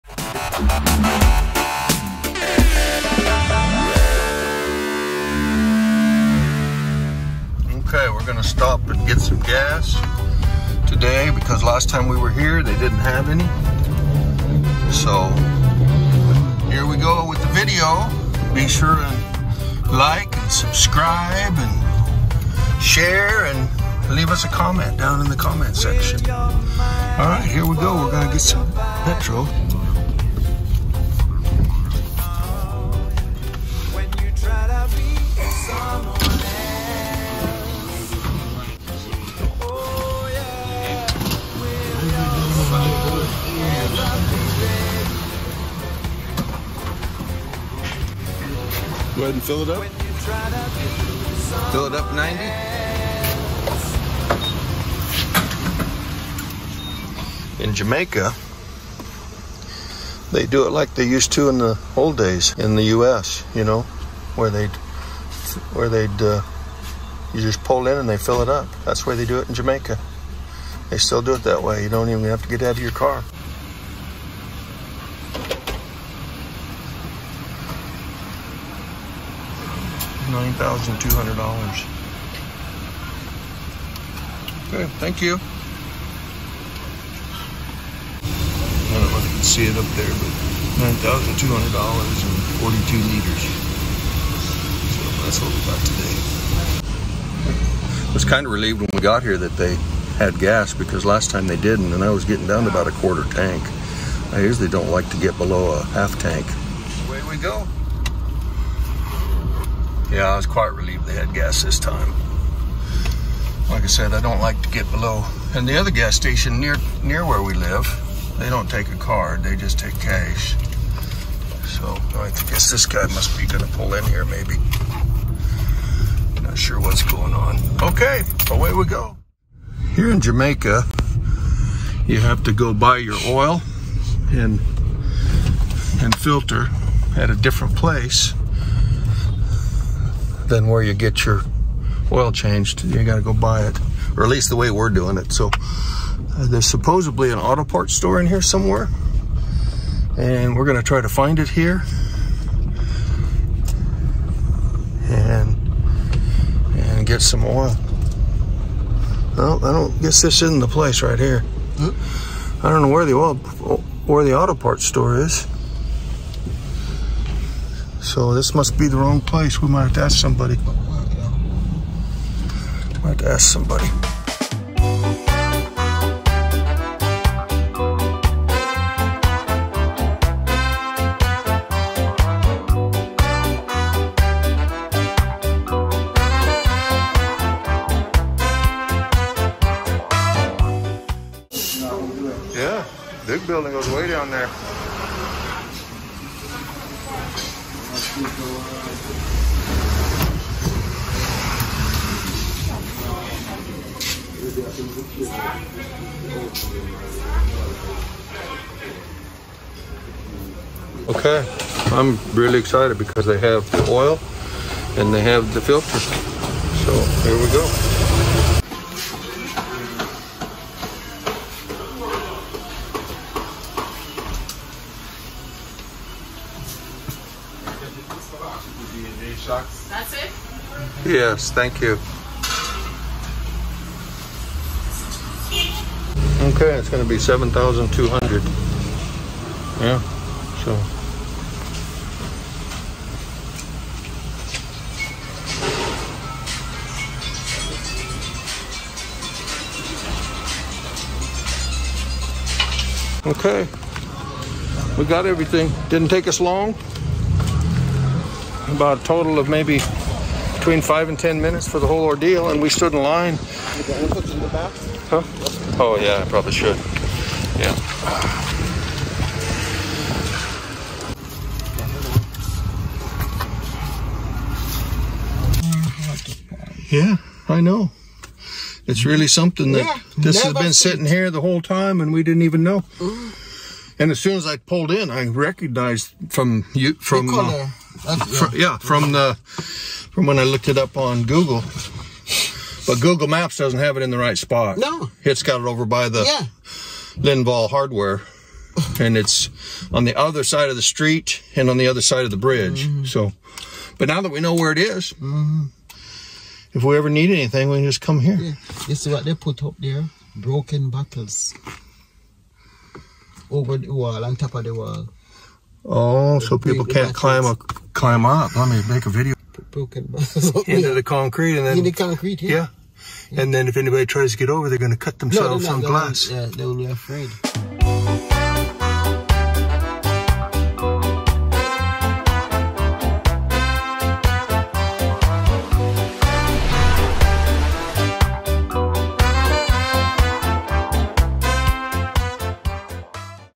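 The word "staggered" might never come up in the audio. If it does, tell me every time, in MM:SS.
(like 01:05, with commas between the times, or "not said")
not said.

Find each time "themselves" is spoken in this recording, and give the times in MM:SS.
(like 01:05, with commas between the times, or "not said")
05:25.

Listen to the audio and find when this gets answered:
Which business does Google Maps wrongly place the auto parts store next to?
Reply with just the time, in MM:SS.
04:57.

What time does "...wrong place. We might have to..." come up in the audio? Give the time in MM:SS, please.
02:48.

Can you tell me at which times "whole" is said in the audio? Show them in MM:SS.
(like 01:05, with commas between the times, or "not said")
04:21, 04:41.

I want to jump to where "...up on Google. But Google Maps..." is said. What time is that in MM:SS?
04:50.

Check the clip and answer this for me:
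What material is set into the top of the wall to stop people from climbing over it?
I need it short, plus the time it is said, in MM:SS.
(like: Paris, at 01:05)
Broken bottles, at 05:10.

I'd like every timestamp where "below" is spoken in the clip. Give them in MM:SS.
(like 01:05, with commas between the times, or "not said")
01:45, 01:54.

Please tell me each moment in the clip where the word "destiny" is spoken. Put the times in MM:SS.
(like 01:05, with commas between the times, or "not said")
not said.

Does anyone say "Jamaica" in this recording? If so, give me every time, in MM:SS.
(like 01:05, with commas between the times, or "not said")
00:57, 01:09, 02:10.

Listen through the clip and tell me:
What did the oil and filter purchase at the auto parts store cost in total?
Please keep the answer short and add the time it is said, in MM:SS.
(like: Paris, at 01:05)
7,200, at 03:57.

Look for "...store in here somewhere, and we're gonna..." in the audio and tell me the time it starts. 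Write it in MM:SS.
02:27.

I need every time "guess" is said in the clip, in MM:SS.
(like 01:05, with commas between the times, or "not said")
02:02, 02:40.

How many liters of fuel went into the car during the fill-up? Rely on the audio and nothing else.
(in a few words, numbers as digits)
42 liters.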